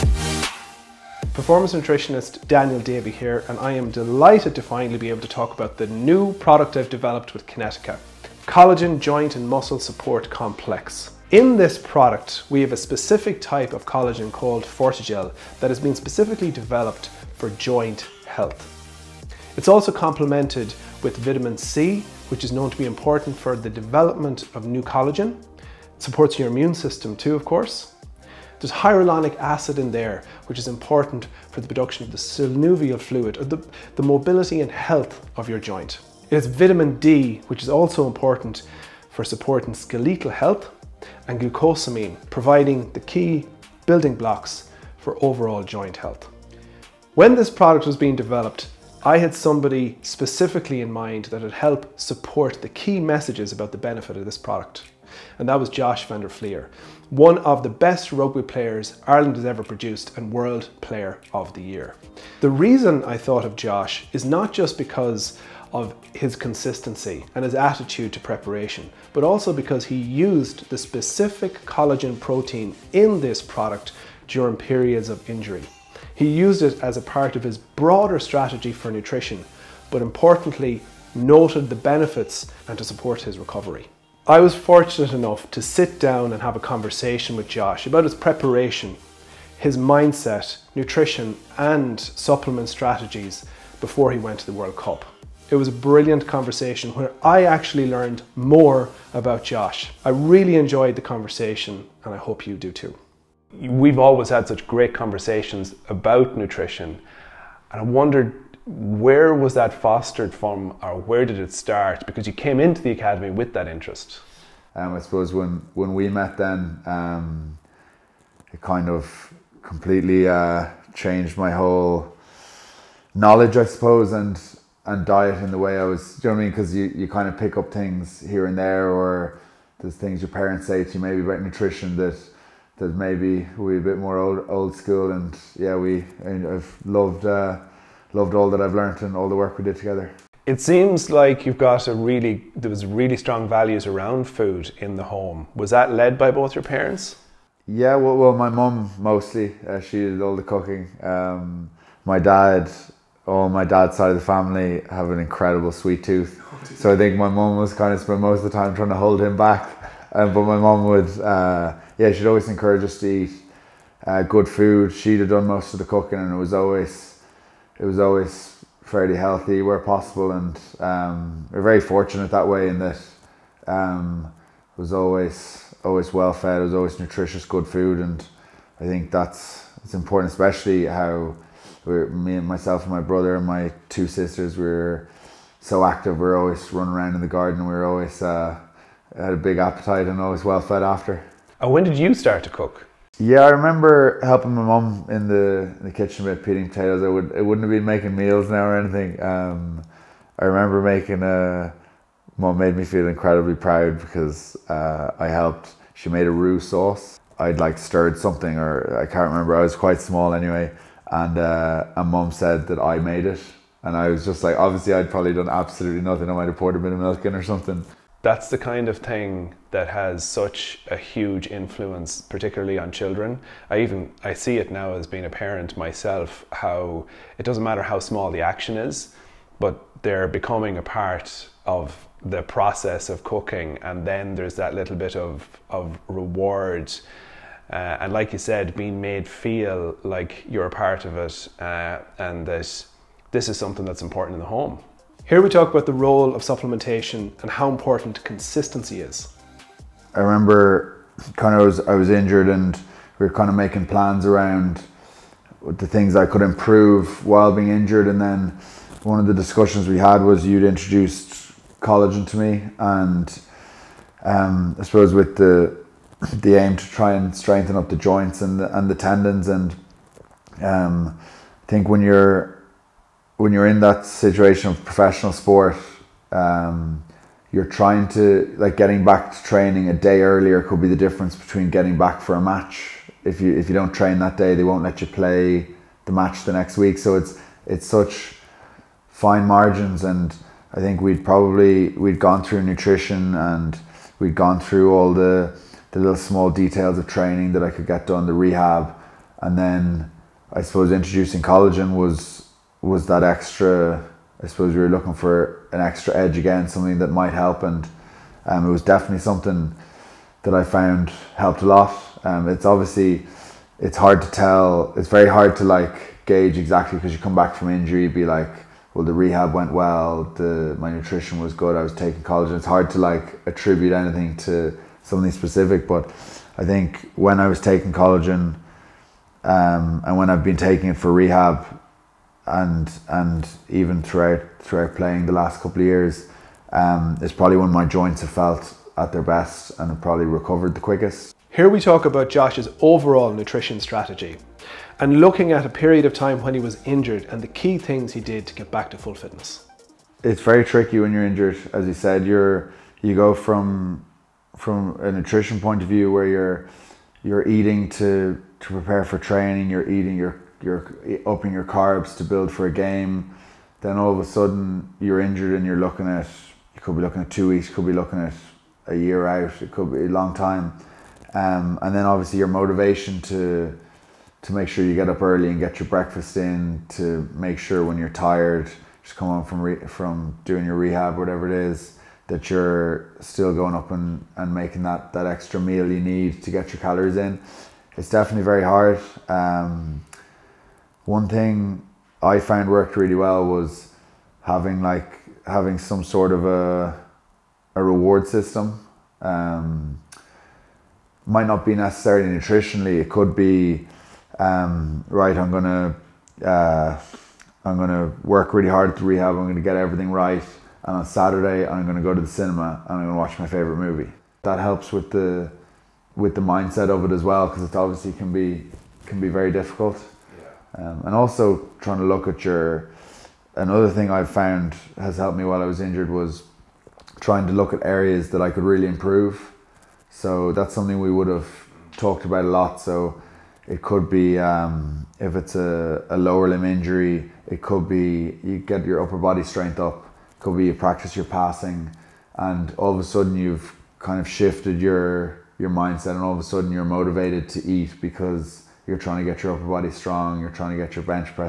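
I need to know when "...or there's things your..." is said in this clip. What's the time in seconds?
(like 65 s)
128 s.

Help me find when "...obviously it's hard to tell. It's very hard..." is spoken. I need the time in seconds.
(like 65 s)
312 s.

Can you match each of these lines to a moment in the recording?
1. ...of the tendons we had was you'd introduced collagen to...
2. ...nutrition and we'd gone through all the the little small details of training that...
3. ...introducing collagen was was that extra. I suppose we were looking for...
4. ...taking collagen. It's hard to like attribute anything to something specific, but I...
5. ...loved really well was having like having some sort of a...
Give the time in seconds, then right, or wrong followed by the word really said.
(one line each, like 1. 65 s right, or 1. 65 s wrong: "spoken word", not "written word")
1. 259 s wrong: "discussions", not "tendons"
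2. 292 s right
3. 300 s right
4. 321 s right
5. 392 s wrong: "worked", not "loved".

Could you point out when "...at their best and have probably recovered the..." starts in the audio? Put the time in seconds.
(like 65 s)
338 s.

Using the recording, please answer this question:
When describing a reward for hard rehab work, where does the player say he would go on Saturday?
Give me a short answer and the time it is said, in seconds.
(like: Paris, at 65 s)
the cinema, at 412 s.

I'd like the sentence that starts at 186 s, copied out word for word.
We are always running around in the garden.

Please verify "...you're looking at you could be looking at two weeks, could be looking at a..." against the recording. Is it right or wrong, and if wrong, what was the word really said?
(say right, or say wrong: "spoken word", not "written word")
right.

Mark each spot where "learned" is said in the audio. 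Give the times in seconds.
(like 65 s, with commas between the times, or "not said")
97 s, 138 s.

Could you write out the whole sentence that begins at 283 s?
If you if you don't train that day, they won't let you play the match the next week.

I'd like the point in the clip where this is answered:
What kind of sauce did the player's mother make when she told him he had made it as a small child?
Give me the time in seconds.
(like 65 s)
206 s.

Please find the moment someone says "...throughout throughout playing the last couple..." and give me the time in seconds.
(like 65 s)
334 s.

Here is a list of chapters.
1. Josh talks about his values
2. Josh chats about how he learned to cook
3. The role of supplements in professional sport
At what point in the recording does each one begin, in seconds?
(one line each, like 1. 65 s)
1. 139 s
2. 191 s
3. 245 s.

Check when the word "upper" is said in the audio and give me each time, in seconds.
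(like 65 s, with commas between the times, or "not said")
439 s, 449 s.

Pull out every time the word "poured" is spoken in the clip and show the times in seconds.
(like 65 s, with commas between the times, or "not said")
216 s.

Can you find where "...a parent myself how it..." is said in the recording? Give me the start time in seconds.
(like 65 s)
225 s.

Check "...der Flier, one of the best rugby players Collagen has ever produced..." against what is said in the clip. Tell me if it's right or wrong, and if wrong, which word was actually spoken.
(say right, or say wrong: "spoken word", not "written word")
wrong: "Ireland", not "Collagen".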